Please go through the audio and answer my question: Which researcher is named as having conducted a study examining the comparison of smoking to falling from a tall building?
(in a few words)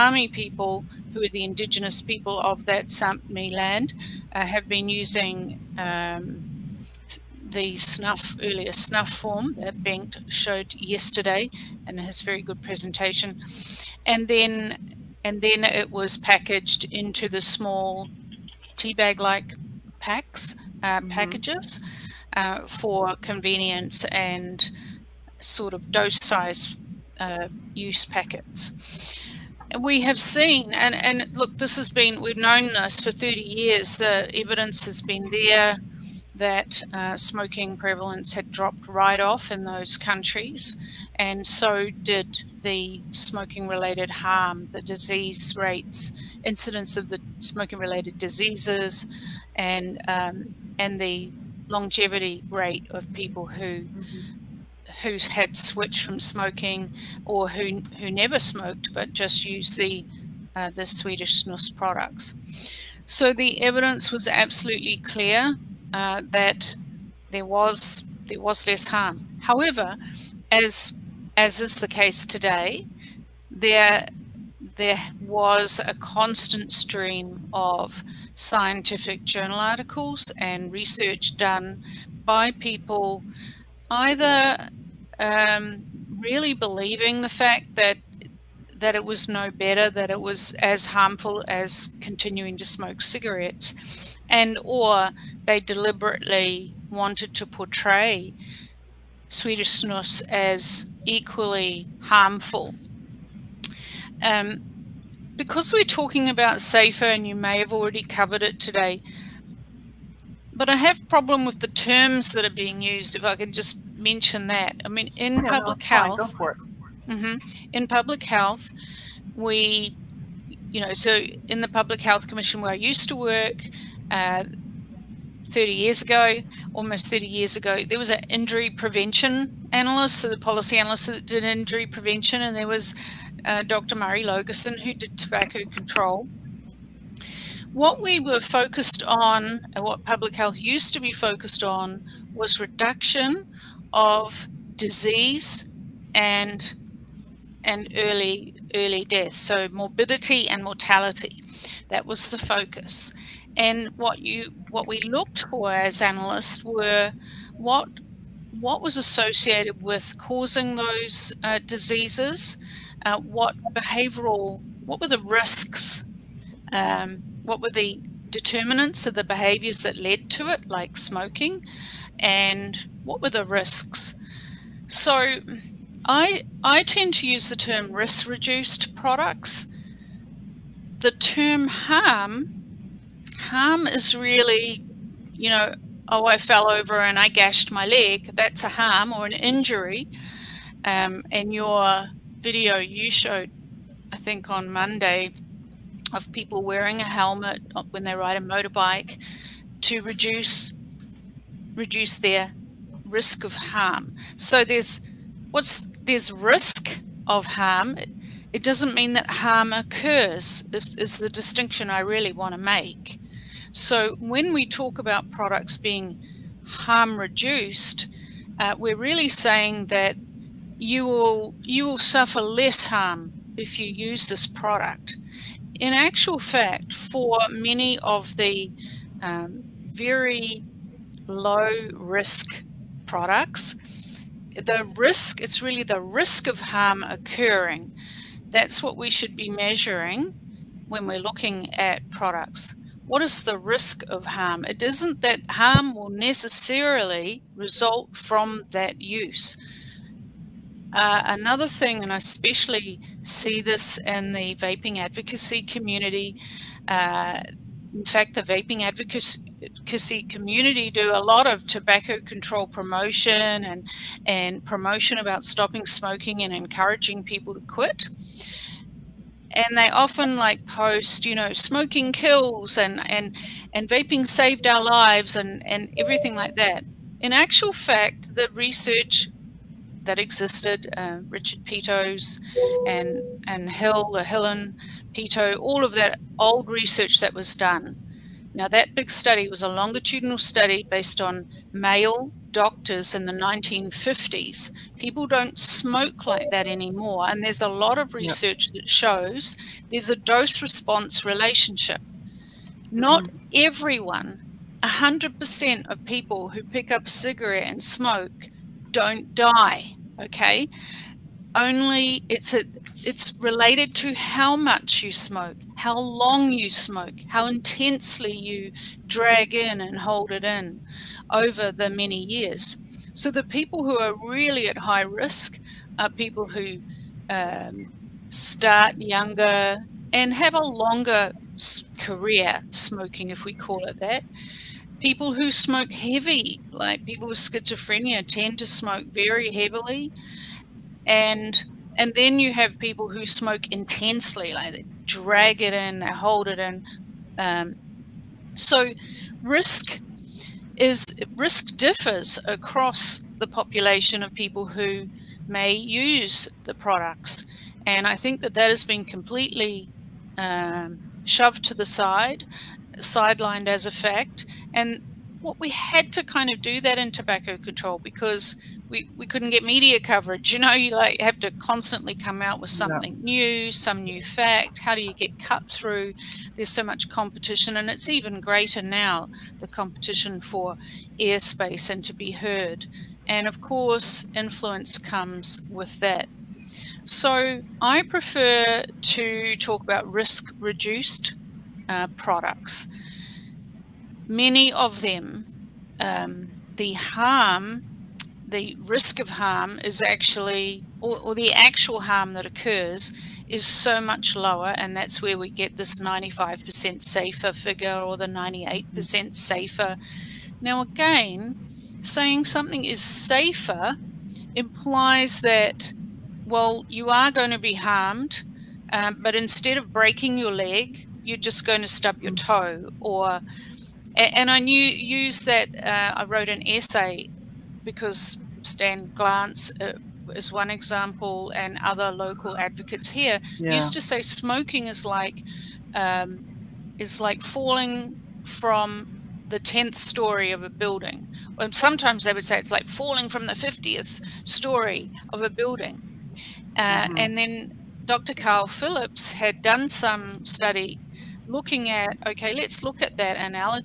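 Dr. Carl Phillips.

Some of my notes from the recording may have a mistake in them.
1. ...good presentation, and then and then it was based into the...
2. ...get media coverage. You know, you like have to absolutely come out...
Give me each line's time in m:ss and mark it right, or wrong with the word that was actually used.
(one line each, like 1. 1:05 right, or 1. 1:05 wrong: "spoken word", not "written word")
1. 0:12 wrong: "packaged", not "based"
2. 6:09 wrong: "constantly", not "absolutely".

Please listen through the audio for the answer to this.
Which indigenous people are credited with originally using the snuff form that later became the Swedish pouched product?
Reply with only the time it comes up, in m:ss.
0:02.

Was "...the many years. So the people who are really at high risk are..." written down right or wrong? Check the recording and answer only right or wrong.
right.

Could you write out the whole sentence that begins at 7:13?
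used to say smoking is like um, is like falling from the tenth story of a building.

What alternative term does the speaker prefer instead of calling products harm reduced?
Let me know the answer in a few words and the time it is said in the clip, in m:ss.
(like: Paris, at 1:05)
risk reduced products, at 2:57.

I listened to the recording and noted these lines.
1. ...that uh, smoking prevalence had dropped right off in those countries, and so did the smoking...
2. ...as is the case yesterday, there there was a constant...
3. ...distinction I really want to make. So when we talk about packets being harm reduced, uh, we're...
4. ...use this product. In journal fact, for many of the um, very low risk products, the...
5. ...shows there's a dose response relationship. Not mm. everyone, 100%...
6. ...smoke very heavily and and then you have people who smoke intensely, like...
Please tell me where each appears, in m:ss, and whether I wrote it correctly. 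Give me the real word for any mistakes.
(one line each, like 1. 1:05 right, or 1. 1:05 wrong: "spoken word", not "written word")
1. 0:36 right
2. 1:11 wrong: "today", not "yesterday"
3. 3:31 wrong: "products", not "packets"
4. 3:43 wrong: "actual", not "journal"
5. 4:58 right
6. 5:38 right.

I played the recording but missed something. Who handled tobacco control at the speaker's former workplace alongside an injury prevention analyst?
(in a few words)
Dr. Murray Laugesen.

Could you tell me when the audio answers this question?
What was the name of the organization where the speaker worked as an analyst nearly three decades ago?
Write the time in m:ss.
2:01.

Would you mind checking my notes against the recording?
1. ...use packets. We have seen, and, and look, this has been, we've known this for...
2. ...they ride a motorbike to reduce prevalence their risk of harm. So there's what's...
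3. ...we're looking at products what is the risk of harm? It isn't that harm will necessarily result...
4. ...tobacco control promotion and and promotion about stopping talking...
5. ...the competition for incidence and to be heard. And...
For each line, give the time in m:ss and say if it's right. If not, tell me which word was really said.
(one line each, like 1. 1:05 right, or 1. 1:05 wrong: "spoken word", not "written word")
1. 0:27 right
2. 3:18 wrong: "reduce", not "prevalence"
3. 4:01 right
4. 4:21 wrong: "smoking", not "talking"
5. 6:19 wrong: "airspace", not "incidence".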